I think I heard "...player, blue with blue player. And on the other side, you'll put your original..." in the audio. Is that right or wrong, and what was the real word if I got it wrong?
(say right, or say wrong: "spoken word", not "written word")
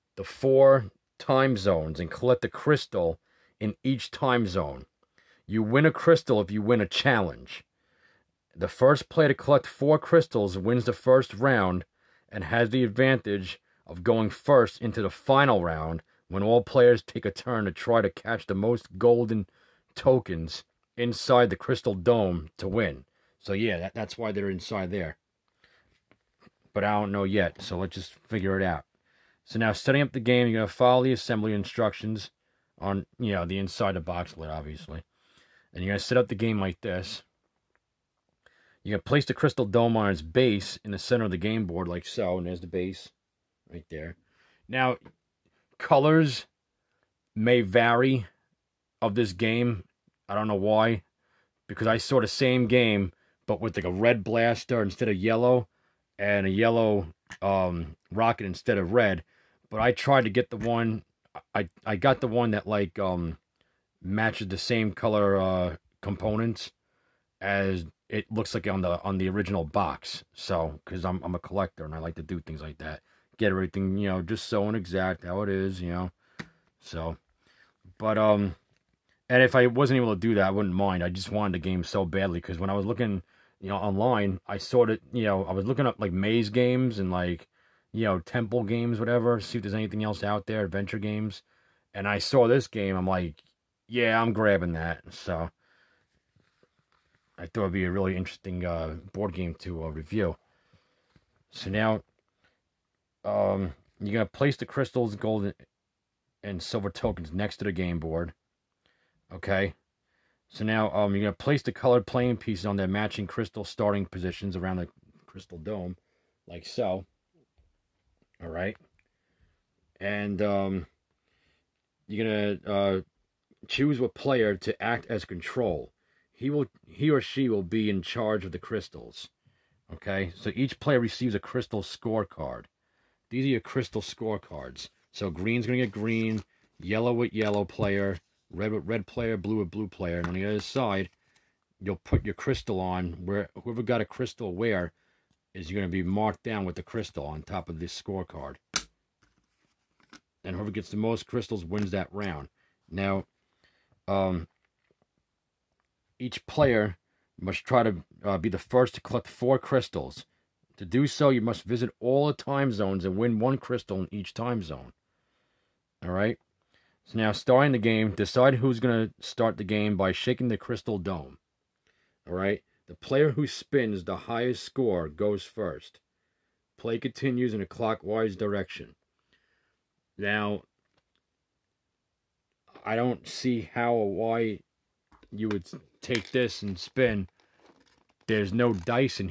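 wrong: "crystal", not "original".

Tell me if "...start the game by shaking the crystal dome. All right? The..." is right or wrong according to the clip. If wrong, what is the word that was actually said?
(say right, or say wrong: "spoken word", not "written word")
right.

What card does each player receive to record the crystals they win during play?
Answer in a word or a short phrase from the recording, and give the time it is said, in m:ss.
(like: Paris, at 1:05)
Crystal scorecard, at 2:11.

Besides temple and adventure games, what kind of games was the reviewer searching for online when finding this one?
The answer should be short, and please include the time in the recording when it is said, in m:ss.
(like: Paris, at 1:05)
Maze games, at 1:26.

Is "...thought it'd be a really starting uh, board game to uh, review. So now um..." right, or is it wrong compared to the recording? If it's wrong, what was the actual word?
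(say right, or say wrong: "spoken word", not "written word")
wrong: "interesting", not "starting".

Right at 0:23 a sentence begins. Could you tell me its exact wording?
So yeah, that, that's why they're inside there.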